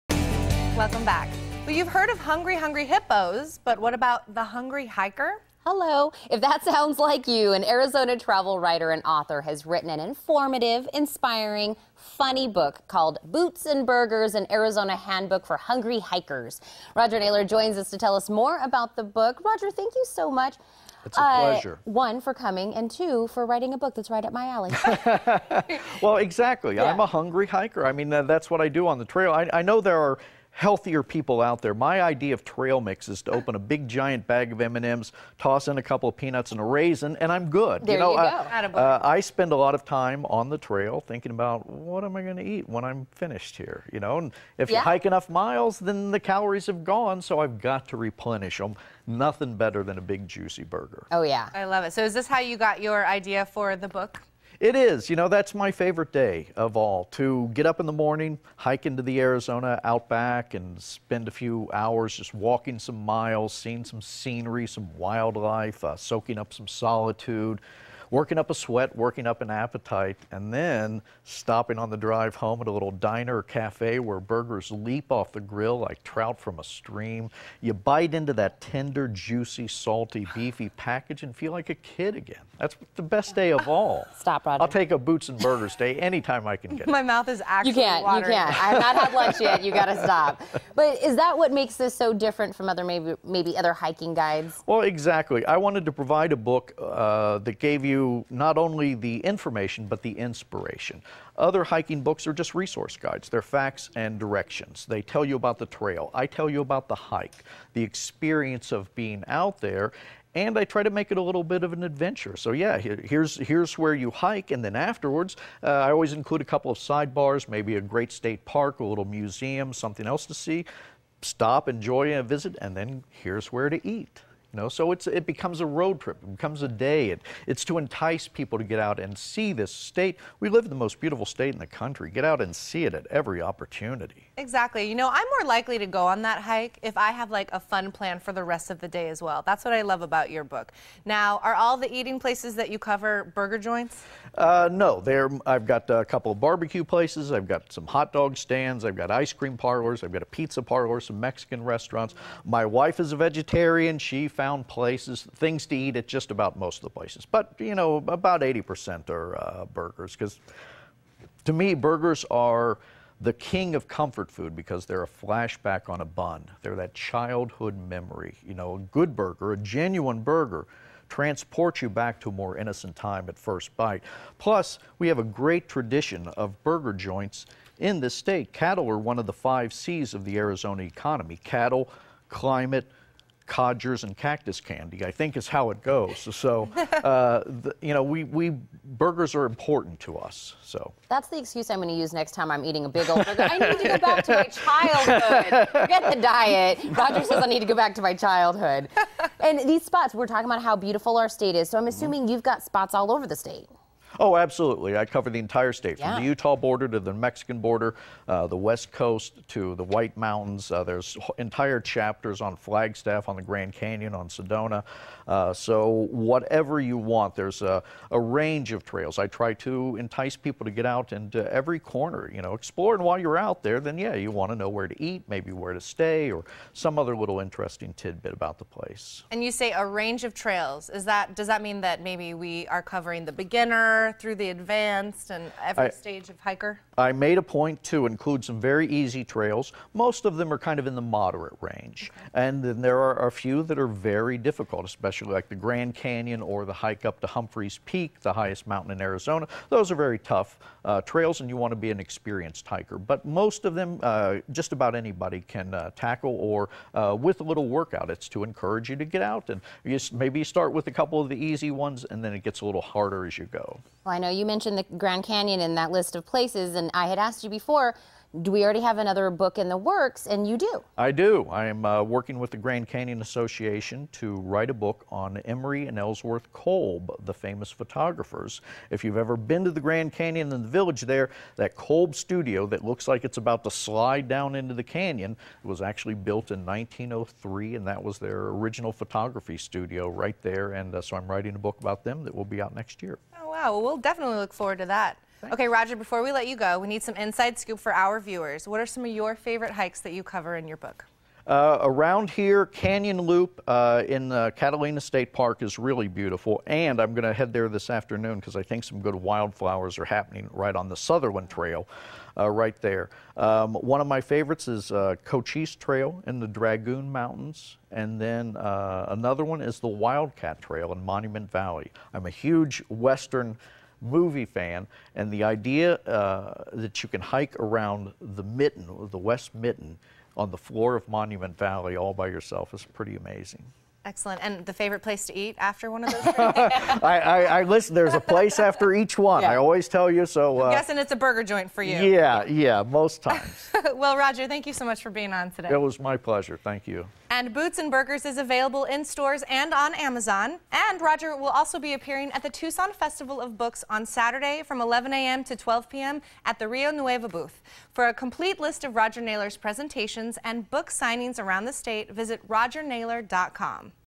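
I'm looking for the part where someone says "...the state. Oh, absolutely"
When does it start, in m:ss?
3:23.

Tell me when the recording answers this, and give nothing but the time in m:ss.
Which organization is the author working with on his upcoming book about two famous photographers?
4:32.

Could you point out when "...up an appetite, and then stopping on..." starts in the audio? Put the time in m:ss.
1:09.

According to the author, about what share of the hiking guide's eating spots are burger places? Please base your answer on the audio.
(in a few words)
80%.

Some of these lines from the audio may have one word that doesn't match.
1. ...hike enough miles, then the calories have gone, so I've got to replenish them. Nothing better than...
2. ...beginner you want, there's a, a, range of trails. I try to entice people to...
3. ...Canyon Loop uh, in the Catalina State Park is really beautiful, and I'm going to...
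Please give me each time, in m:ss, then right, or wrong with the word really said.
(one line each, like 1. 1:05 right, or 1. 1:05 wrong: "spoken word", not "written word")
1. 0:44 right
2. 3:36 wrong: "whatever", not "beginner"
3. 5:02 right.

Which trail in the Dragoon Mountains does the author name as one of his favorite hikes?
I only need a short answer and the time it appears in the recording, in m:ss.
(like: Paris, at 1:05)
Cochise Trail, at 5:15.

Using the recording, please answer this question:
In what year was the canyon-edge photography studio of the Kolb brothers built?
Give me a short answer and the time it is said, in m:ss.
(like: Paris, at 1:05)
1903, at 4:46.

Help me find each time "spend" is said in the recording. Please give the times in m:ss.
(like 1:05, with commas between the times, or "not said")
0:39, 1:00.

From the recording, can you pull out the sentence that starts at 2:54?
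Plus, we have a great tradition of burger joints in this state.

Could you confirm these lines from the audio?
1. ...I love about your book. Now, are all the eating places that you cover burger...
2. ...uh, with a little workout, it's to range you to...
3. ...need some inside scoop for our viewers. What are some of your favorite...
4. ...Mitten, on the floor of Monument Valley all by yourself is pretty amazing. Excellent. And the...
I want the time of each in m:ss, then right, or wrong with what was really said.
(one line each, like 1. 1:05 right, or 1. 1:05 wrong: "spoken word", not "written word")
1. 2:19 right
2. 4:16 wrong: "encourage", not "range"
3. 4:56 right
4. 5:29 right.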